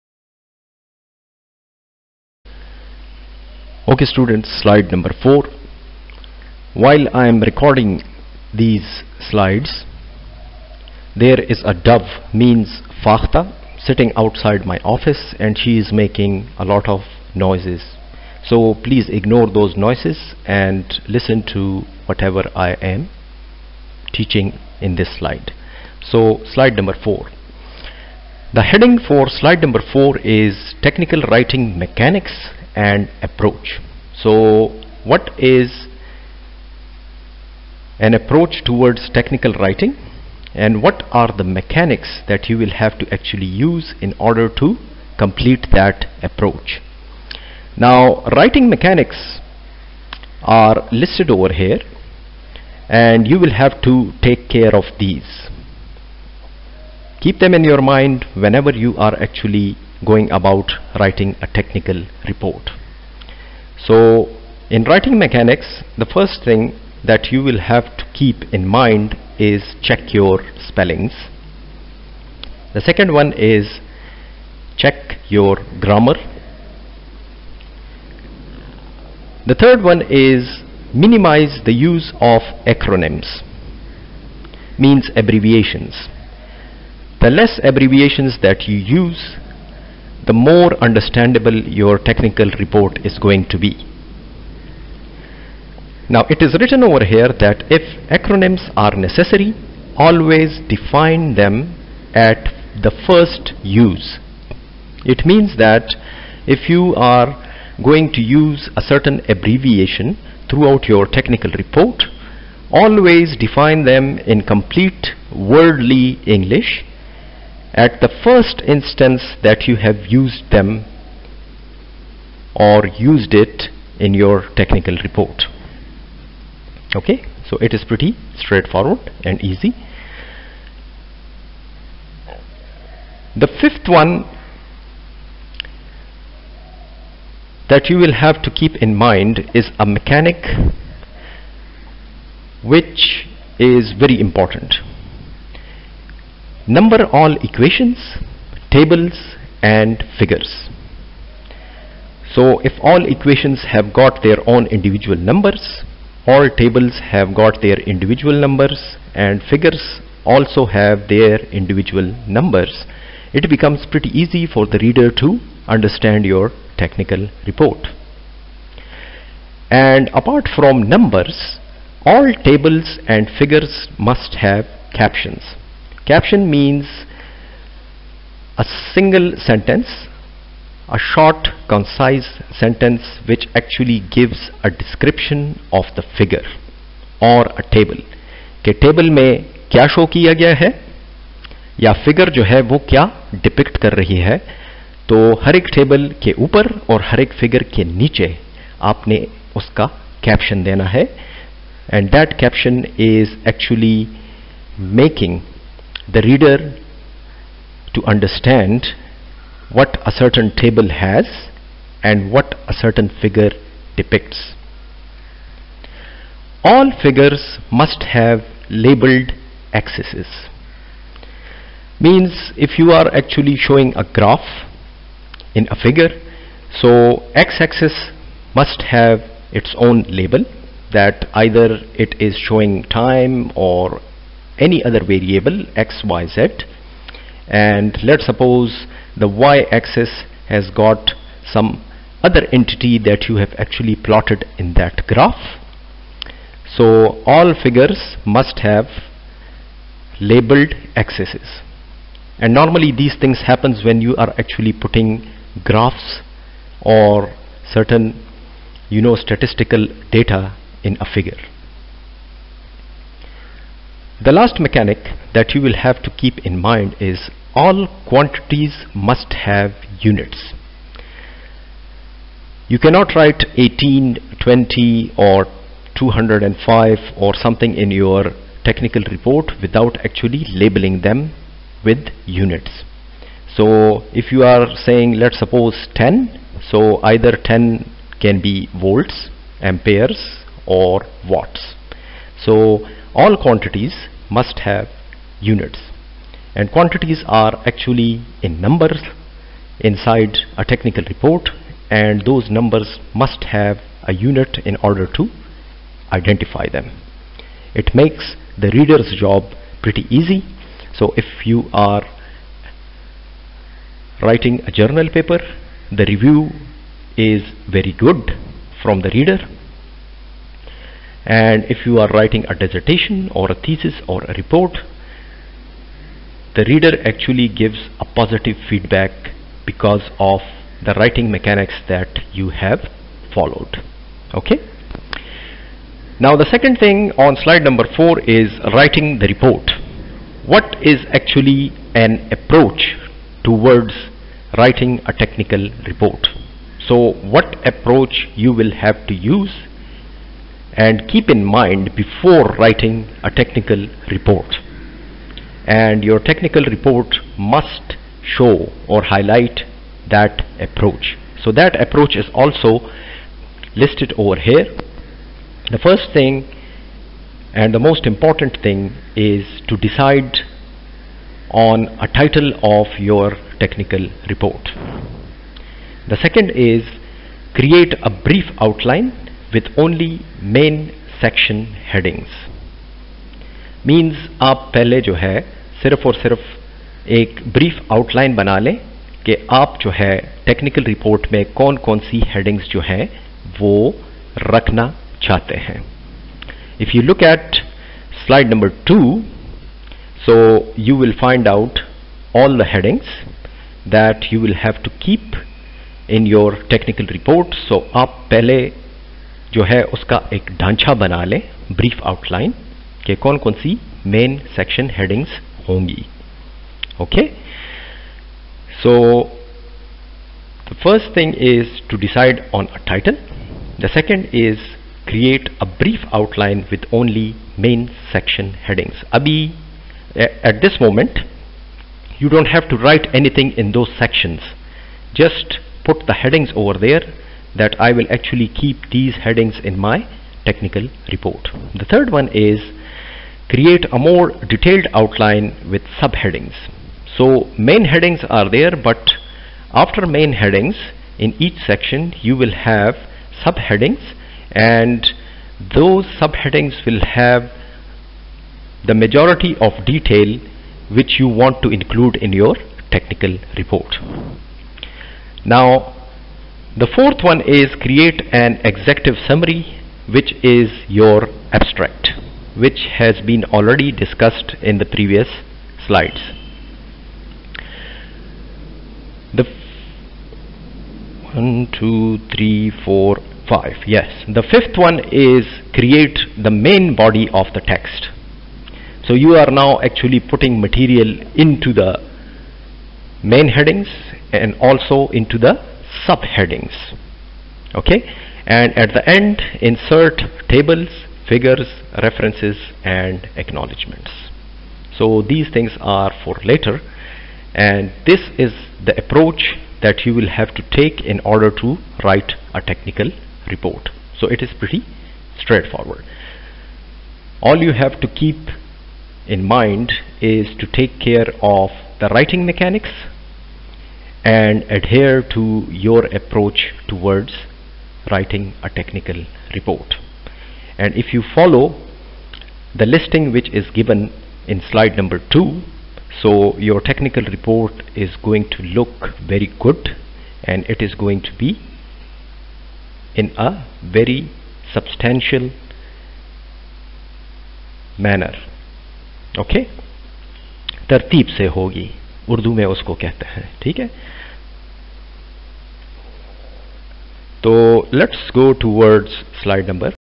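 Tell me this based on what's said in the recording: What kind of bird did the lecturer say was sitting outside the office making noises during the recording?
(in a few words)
Dove.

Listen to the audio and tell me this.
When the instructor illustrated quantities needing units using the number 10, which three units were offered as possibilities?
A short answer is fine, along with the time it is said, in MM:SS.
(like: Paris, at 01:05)
Volts, amperes or watts, at 04:48.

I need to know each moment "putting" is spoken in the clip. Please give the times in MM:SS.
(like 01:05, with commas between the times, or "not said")
04:14, 08:10.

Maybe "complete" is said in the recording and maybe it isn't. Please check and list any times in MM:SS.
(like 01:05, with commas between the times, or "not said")
00:45, 01:54.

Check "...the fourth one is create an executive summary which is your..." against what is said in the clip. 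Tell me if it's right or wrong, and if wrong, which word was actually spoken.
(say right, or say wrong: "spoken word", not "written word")
right.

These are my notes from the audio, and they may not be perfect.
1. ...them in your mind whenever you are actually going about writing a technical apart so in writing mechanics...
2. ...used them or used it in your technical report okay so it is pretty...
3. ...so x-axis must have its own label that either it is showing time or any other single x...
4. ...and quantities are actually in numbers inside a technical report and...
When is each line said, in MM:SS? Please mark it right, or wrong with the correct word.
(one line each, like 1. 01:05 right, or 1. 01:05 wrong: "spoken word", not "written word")
1. 00:57 wrong: "report", not "apart"
2. 02:00 right
3. 03:46 wrong: "variable", not "single"
4. 04:56 right.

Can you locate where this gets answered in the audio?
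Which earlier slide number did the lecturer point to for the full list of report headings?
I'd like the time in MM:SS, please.
06:38.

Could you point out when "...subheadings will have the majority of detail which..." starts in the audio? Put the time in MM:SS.
07:36.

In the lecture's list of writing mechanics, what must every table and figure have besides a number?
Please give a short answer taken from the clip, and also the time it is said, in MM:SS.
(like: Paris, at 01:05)
Captions, at 02:54.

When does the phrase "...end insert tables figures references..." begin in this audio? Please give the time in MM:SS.
08:19.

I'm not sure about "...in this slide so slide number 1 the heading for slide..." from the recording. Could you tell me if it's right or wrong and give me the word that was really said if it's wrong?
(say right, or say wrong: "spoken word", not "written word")
wrong: "4", not "1".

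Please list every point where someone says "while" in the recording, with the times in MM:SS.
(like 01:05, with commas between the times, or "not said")
00:06.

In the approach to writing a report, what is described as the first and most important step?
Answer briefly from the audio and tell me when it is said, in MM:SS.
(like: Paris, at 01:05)
Decide on a title, at 06:09.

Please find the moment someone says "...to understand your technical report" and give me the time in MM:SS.
02:45.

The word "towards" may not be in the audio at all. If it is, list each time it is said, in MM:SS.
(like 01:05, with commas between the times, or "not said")
00:38, 05:43, 08:46.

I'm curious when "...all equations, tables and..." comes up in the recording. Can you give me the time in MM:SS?
02:27.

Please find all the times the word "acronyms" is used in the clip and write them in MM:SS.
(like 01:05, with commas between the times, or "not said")
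01:22, 01:38.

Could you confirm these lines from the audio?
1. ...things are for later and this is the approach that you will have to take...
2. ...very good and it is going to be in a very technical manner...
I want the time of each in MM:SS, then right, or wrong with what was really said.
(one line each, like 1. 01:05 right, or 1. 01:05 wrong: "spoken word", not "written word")
1. 08:25 right
2. 08:59 wrong: "substantial", not "technical".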